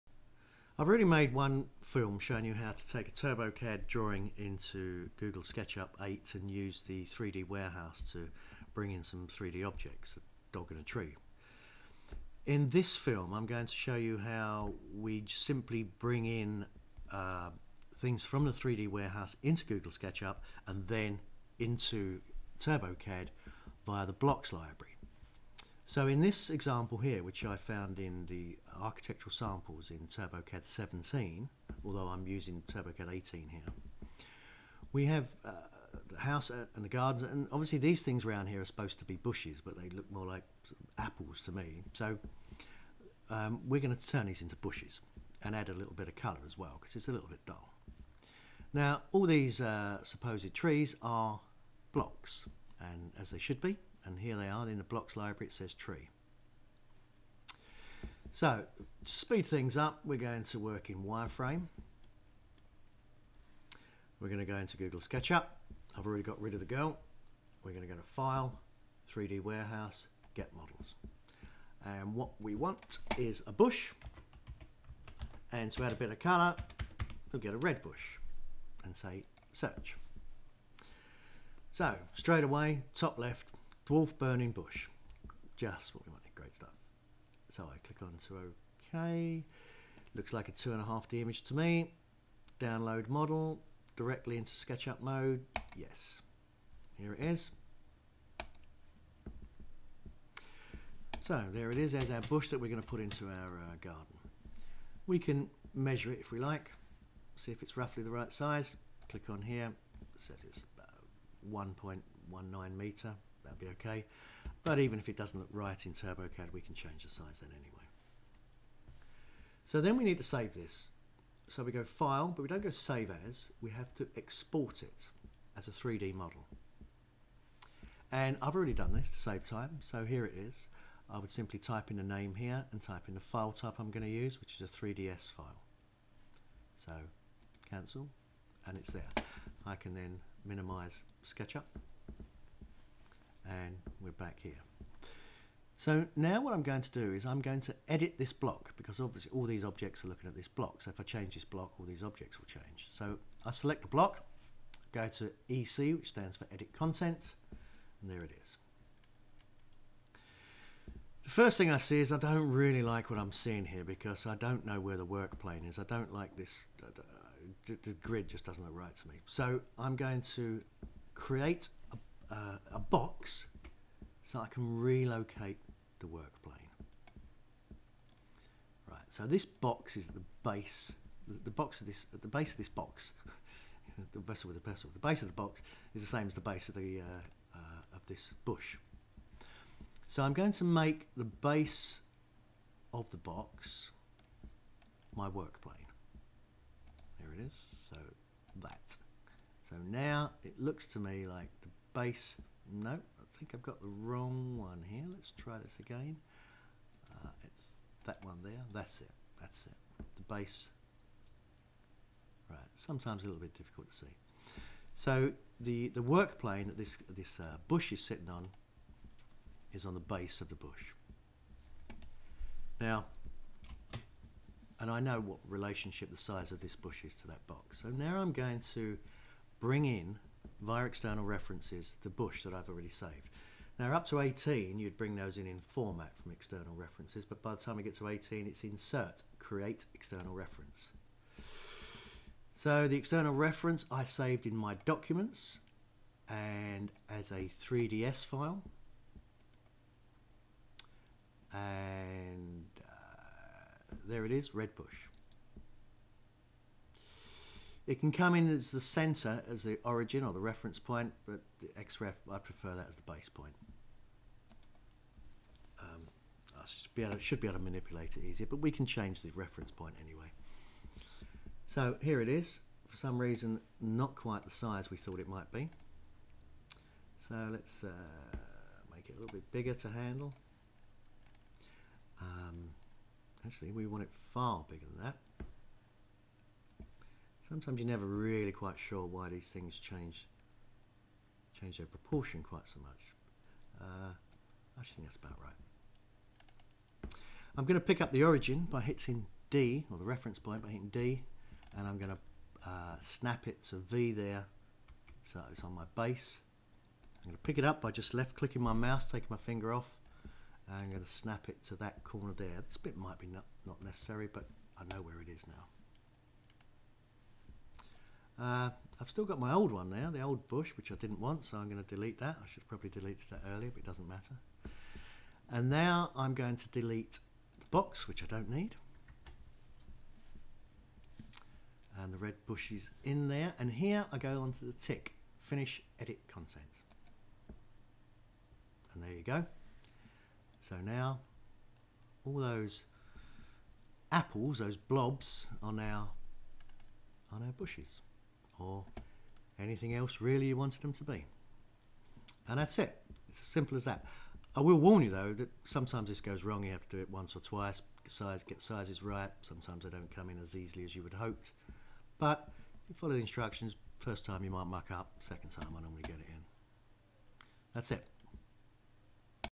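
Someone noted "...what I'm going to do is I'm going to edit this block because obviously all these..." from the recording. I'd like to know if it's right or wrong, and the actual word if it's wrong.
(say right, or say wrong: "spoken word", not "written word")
right.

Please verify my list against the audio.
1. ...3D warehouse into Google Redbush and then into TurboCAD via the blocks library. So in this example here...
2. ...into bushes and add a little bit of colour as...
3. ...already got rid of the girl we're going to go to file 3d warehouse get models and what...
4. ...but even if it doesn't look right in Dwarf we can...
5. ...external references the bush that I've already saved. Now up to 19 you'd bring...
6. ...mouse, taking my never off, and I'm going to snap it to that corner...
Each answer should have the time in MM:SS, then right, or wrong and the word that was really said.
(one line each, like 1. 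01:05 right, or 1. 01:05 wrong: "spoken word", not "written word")
1. 00:18 wrong: "SketchUp", not "Redbush"
2. 00:44 right
3. 01:06 right
4. 01:54 wrong: "TurboCAD", not "Dwarf"
5. 03:50 wrong: "18", not "19"
6. 05:08 wrong: "finger", not "never".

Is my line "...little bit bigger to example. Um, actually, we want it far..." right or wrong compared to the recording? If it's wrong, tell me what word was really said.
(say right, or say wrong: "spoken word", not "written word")
wrong: "handle", not "example".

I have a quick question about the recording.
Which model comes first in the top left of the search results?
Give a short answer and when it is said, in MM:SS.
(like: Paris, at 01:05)
Dwarf Burning Bush, at 01:23.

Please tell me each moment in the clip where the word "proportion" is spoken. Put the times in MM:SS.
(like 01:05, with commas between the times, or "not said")
04:51.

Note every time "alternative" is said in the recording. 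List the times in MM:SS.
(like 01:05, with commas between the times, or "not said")
not said.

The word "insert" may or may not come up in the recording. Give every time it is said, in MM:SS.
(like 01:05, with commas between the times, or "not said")
03:58.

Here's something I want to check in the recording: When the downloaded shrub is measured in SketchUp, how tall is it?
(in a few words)
1.19 metres.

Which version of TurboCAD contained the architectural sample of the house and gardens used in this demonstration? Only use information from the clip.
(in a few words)
TurboCAD 17.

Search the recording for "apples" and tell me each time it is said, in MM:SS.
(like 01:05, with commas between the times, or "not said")
00:40, 05:44.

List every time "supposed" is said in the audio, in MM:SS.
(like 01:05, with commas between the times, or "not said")
00:38, 00:50.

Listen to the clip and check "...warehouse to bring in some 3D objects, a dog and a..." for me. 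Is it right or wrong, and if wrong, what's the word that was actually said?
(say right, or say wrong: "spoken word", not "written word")
right.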